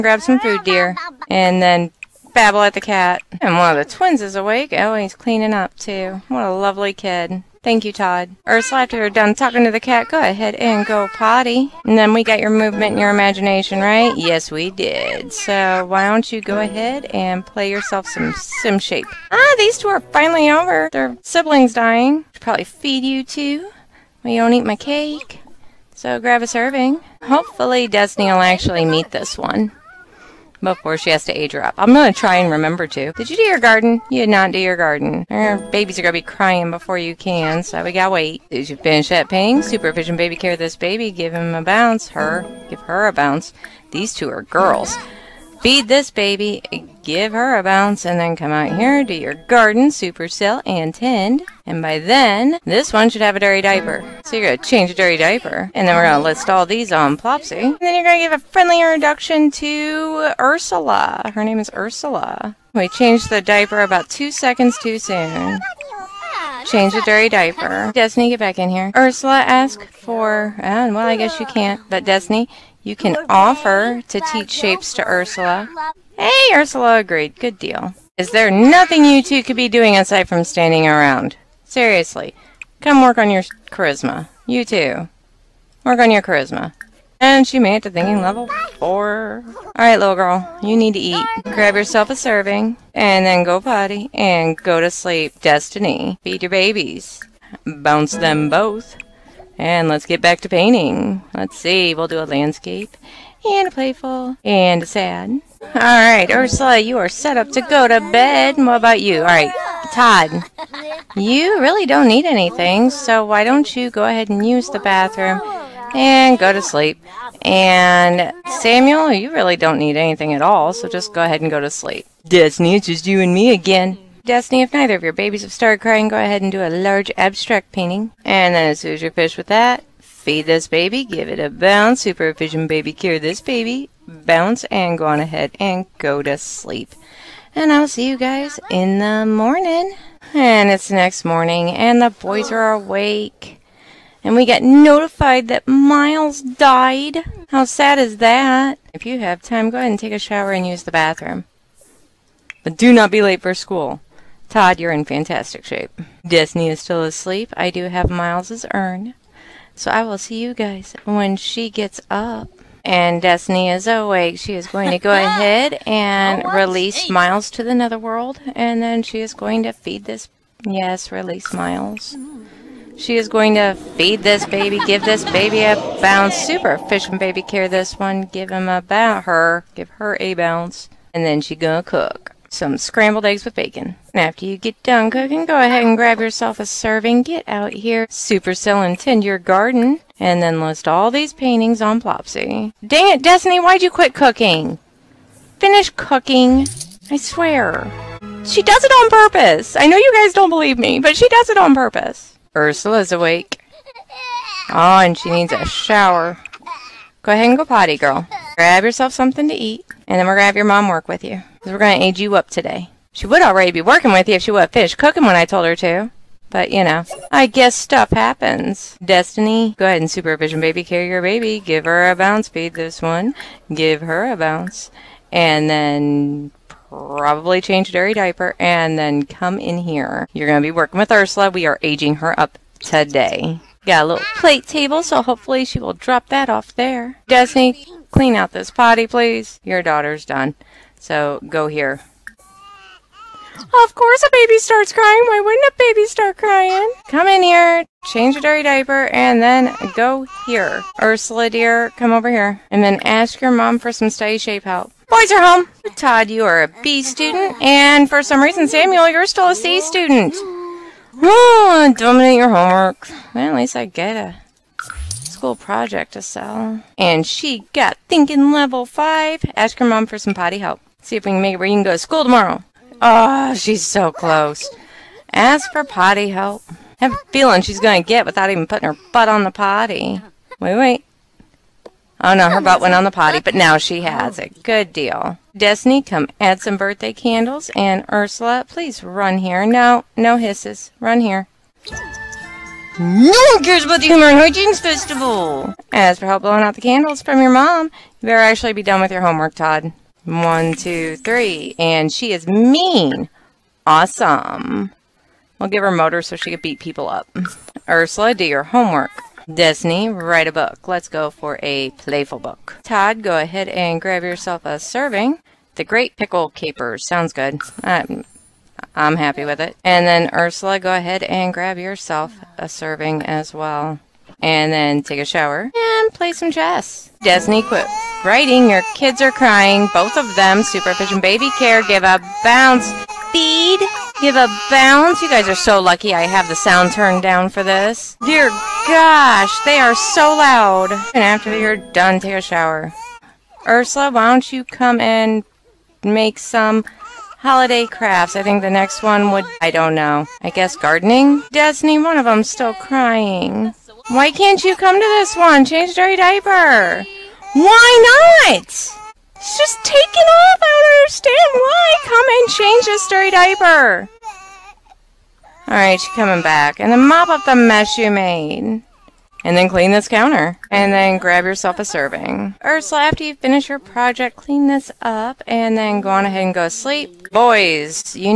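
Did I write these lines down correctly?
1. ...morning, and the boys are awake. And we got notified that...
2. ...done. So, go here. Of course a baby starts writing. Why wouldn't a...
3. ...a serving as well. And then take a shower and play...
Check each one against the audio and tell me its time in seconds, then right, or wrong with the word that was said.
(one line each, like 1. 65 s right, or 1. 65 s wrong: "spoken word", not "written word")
1. 141 s right
2. 240 s wrong: "crying", not "writing"
3. 322 s right.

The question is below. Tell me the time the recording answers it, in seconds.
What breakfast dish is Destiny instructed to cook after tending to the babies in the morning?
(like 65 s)
182 s.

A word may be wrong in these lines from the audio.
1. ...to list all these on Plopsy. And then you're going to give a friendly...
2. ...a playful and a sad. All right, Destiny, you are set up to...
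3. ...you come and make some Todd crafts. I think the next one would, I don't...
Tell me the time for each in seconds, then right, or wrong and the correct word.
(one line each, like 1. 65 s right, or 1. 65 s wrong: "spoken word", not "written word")
1. 56 s right
2. 103 s wrong: "Ursula", not "Destiny"
3. 344 s wrong: "Holiday", not "Todd".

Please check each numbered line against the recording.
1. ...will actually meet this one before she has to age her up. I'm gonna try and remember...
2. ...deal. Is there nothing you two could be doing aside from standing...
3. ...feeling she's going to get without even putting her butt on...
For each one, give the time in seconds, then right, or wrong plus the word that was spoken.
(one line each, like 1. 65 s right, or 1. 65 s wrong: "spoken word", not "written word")
1. 28 s right
2. 77 s right
3. 277 s right.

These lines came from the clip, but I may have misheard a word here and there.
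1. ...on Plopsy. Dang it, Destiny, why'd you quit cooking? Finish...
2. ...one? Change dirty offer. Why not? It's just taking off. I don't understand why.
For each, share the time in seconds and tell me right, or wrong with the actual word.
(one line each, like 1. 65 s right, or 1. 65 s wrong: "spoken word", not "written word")
1. 191 s right
2. 355 s wrong: "diaper", not "offer".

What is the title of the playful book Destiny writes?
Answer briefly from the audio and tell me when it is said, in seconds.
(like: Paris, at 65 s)
The Great Pickle Capers, at 315 s.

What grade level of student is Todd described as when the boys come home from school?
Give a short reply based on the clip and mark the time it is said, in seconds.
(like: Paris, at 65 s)
B student, at 256 s.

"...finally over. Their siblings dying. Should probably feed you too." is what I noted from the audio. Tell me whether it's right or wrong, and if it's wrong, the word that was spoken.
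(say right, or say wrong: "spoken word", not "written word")
right.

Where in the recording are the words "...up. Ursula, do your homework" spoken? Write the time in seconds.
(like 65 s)
307 s.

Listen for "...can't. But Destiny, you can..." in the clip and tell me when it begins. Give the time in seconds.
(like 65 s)
71 s.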